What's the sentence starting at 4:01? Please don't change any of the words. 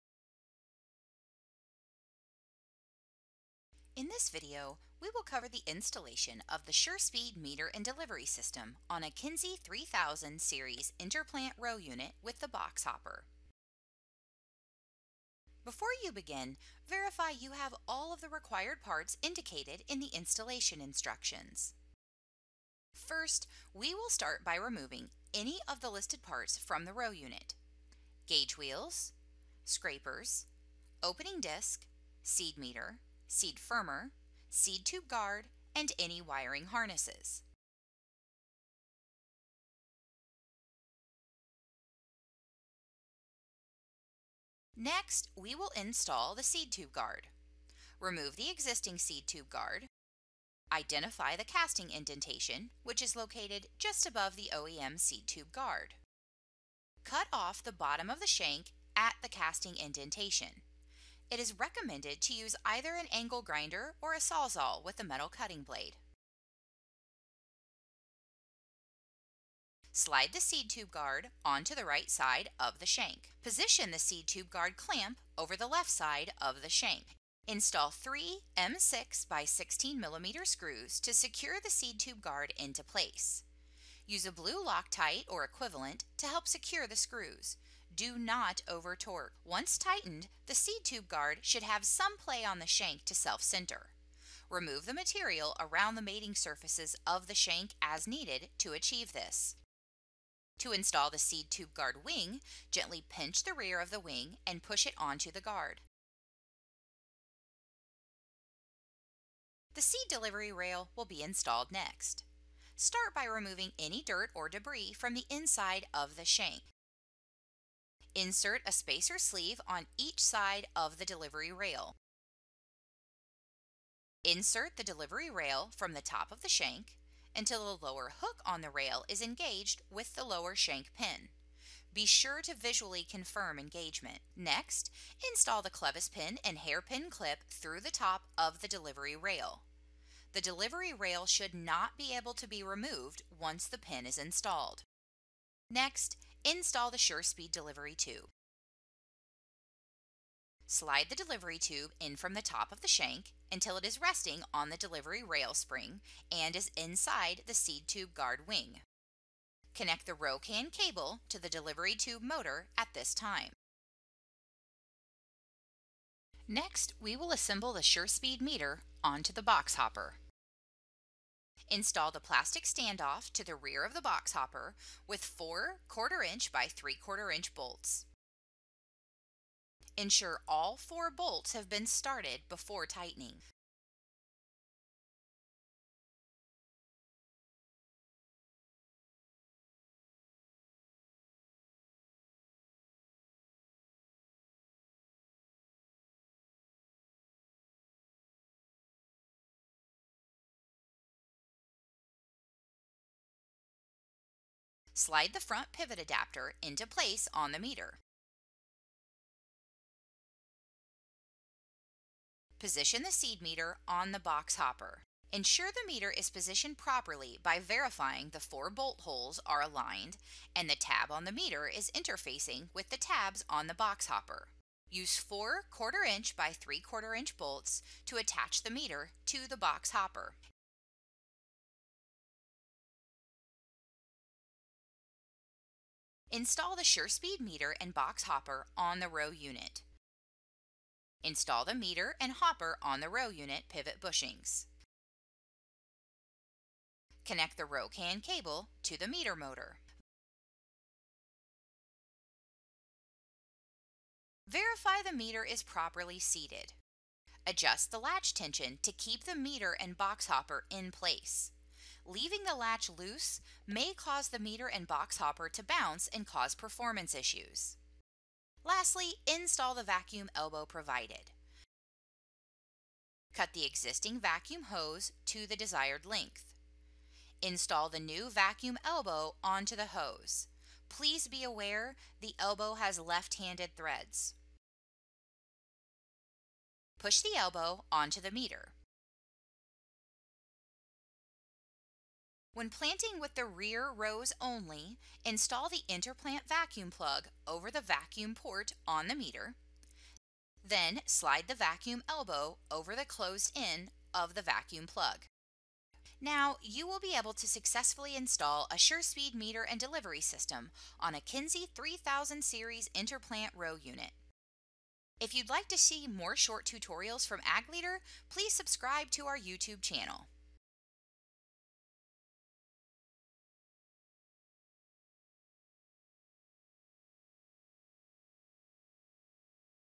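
Install the meter and hopper on the row unit pivot bushings.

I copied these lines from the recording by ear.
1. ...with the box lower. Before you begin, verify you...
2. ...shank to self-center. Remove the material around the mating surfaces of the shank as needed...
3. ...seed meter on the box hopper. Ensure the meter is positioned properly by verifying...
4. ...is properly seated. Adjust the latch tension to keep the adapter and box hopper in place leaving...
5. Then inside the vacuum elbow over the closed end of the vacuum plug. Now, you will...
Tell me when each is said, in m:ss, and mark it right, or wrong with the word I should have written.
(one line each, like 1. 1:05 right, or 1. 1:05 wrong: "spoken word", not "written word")
1. 0:12 wrong: "hopper", not "lower"
2. 1:32 right
3. 3:33 right
4. 4:15 wrong: "meter", not "adapter"
5. 5:00 wrong: "slide", not "inside".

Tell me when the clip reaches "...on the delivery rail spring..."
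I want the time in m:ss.
2:34.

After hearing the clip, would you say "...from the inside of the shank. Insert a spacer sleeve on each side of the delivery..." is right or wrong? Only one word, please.
right.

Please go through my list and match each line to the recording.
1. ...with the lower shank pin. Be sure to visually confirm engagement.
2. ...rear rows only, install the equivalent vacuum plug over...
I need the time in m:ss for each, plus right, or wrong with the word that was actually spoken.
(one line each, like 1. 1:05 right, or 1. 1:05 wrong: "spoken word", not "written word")
1. 2:09 right
2. 4:53 wrong: "interplant", not "equivalent".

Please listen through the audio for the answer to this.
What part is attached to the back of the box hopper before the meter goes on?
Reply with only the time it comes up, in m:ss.
2:52.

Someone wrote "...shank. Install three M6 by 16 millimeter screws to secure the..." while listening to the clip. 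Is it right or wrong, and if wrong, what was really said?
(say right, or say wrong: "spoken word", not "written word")
right.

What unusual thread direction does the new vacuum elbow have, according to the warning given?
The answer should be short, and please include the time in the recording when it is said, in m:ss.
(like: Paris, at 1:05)
left-handed, at 4:42.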